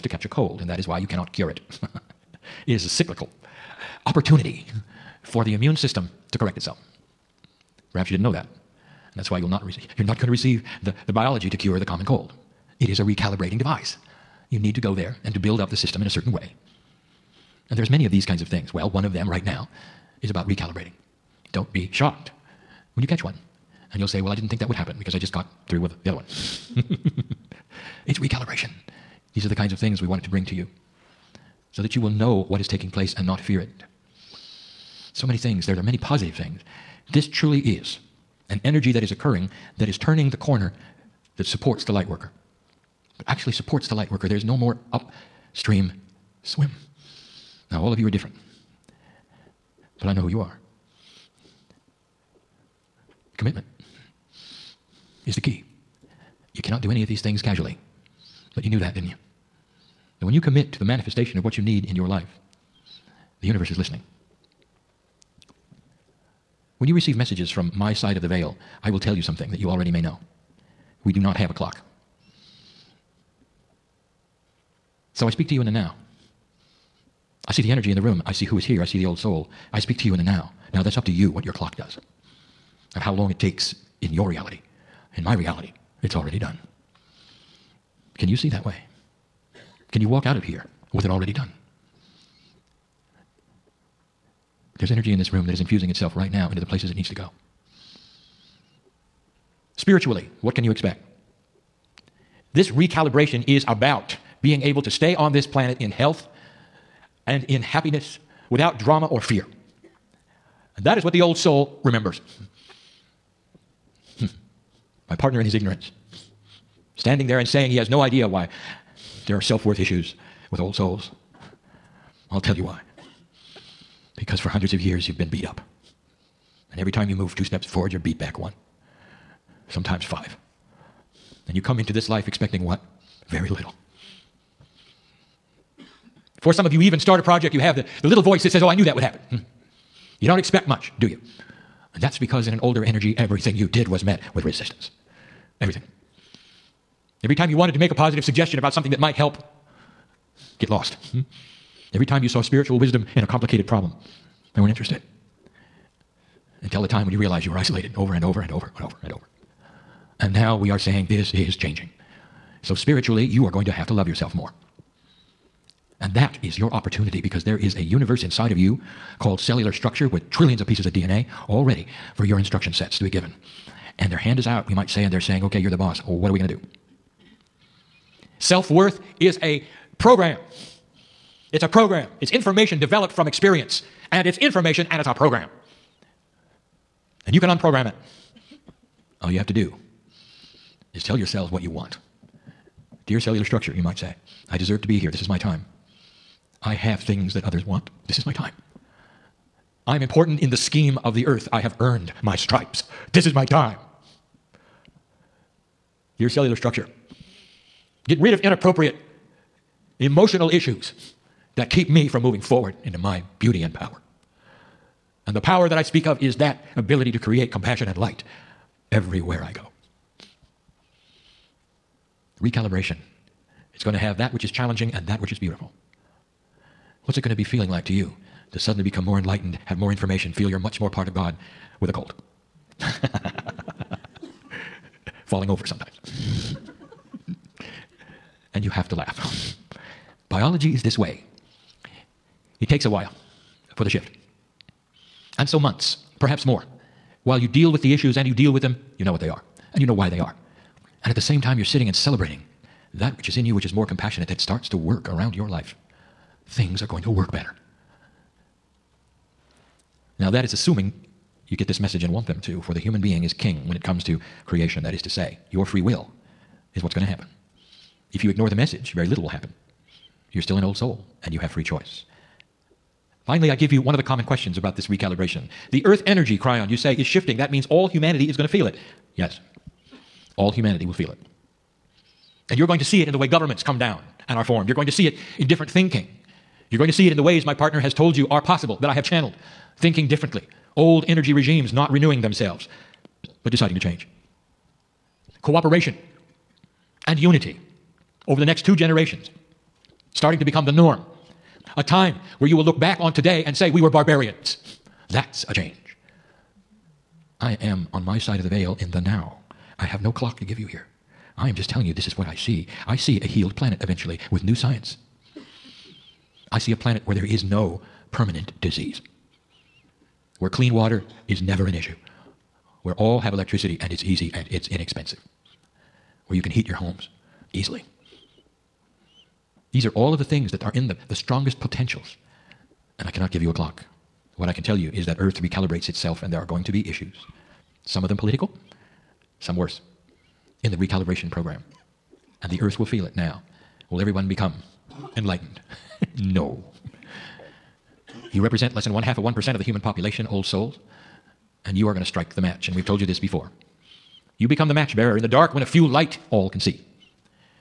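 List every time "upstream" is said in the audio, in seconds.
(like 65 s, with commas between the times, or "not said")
44 s.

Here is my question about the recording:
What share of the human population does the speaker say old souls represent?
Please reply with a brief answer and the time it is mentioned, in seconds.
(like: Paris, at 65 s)
less than half of 1%, at 348 s.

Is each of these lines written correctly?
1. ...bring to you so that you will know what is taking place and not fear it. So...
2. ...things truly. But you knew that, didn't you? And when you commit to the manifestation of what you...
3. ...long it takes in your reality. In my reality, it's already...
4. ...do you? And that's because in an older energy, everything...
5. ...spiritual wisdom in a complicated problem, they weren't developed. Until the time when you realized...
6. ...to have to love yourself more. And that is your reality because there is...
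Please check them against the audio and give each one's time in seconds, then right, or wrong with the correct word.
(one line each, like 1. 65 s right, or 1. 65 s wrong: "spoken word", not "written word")
1. 30 s right
2. 57 s wrong: "casually", not "truly"
3. 83 s right
4. 140 s right
5. 152 s wrong: "interested", not "developed"
6. 163 s wrong: "opportunity", not "reality".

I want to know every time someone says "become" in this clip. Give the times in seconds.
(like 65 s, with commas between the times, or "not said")
228 s, 300 s, 344 s, 354 s.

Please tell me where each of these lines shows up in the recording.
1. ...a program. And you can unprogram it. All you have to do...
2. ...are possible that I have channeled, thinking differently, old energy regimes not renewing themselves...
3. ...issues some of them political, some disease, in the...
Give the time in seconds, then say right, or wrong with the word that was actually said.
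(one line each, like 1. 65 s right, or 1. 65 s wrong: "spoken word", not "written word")
1. 185 s right
2. 288 s right
3. 336 s wrong: "worse", not "disease".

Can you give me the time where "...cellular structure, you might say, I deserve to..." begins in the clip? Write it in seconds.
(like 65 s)
193 s.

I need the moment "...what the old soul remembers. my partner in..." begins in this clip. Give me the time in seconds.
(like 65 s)
111 s.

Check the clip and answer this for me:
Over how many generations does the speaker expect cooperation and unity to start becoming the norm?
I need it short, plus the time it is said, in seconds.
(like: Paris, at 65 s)
2, at 298 s.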